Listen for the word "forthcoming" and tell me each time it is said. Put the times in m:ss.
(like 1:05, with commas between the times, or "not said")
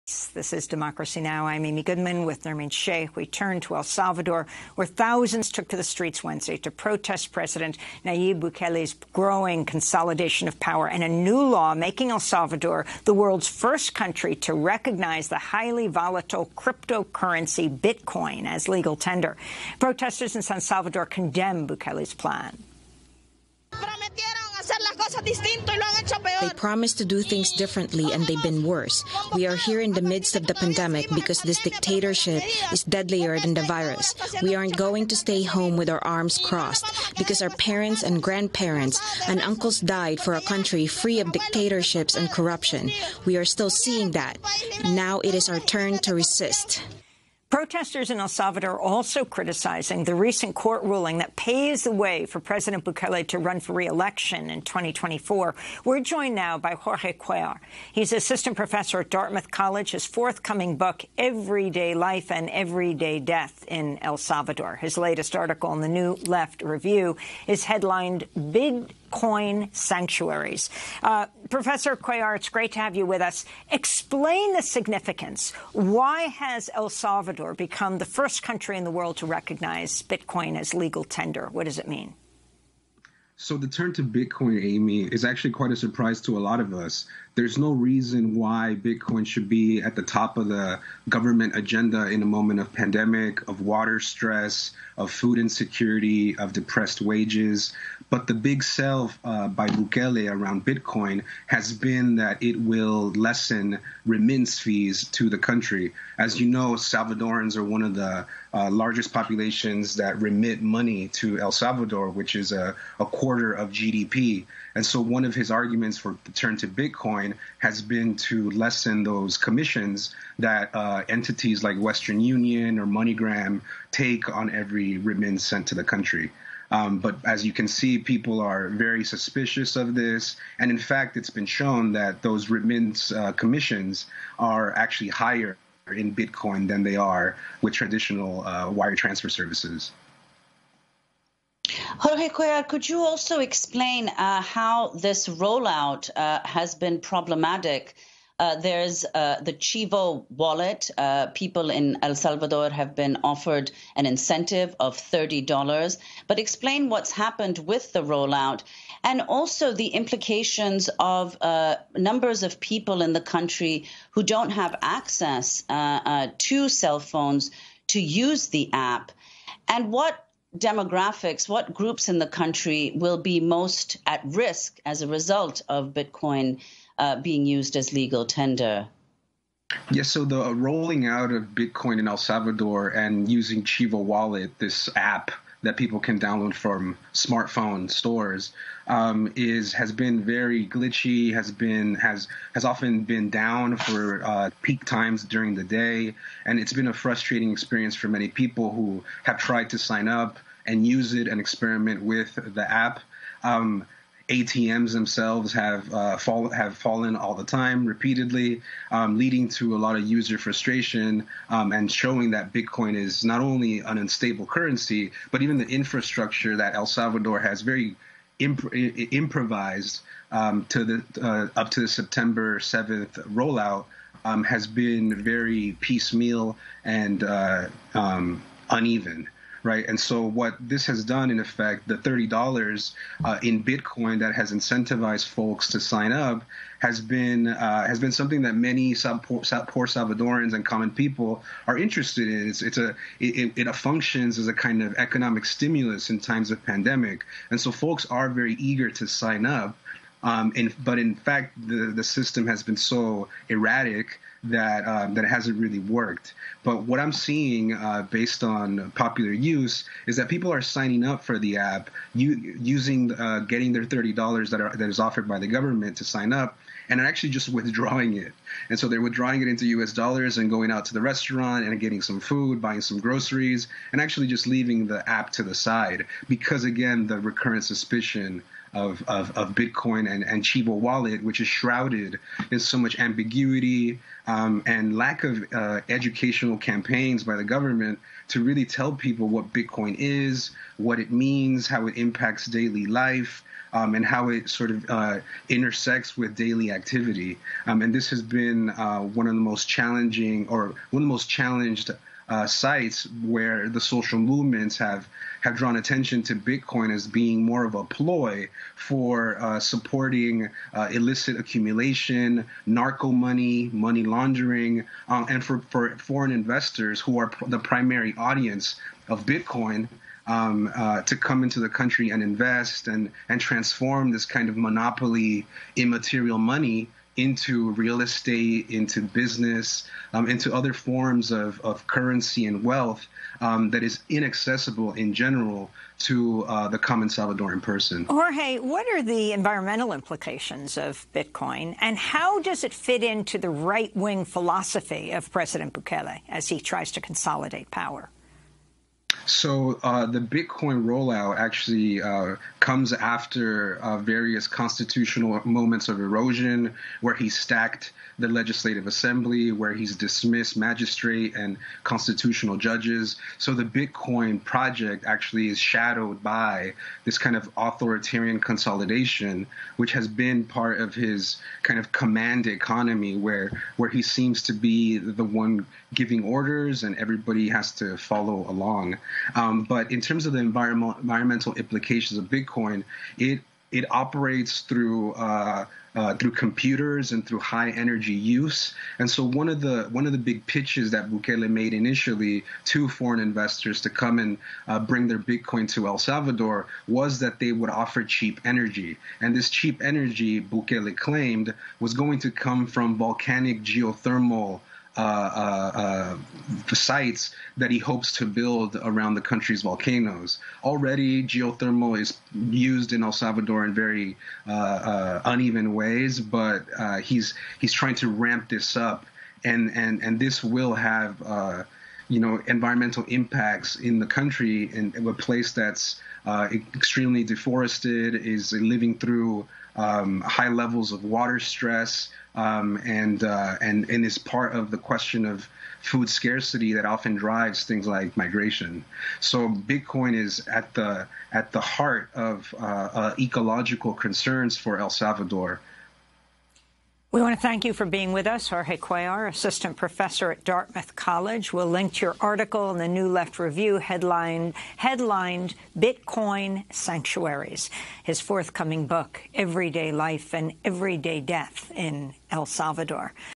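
1:00, 7:38.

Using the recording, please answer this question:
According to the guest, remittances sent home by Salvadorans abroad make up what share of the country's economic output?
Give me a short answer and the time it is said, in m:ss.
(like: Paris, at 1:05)
a quarter of GDP, at 1:52.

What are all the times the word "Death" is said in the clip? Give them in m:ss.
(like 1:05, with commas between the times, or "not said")
1:03, 7:41.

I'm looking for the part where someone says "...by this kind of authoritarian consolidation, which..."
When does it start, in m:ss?
6:06.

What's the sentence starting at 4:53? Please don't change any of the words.
Um, and how it sort of uh, intersects with daily activity.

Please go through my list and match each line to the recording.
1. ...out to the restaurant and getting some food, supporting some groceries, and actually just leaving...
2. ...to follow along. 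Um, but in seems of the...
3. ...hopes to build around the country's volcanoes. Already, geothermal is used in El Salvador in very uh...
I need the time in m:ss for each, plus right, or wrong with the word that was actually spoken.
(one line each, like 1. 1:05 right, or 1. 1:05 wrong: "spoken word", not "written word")
1. 4:30 wrong: "buying", not "supporting"
2. 6:17 wrong: "terms", not "seems"
3. 6:47 right.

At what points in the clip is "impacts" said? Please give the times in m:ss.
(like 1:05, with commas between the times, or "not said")
4:51, 7:03.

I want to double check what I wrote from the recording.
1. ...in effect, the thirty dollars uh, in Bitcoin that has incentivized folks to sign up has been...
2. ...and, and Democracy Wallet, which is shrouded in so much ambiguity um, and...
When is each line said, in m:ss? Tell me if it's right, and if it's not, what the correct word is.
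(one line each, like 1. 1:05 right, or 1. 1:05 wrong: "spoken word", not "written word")
1. 3:51 right
2. 4:40 wrong: "Chivo", not "Democracy".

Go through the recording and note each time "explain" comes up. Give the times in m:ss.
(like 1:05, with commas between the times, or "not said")
1:13, 2:23, 2:36.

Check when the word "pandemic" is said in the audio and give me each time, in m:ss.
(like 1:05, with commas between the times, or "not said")
0:30, 1:32, 4:06.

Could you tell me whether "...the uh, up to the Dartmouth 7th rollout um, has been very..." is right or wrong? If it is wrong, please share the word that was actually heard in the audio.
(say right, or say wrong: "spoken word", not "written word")
wrong: "September", not "Dartmouth".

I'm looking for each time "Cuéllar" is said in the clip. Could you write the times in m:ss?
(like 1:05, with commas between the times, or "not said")
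0:57, 1:11, 2:22, 7:28.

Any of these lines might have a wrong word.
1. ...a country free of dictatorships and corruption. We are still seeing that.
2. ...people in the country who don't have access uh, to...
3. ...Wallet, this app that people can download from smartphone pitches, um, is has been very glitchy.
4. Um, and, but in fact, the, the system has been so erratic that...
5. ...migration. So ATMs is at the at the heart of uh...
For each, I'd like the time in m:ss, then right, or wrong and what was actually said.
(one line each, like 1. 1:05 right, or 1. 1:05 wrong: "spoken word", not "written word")
1. 0:40 right
2. 2:42 right
3. 3:04 wrong: "stores", not "pitches"
4. 4:10 right
5. 7:18 wrong: "Bitcoin", not "ATMs".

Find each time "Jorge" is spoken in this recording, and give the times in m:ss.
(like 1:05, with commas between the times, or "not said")
0:56, 2:21, 5:38, 7:28.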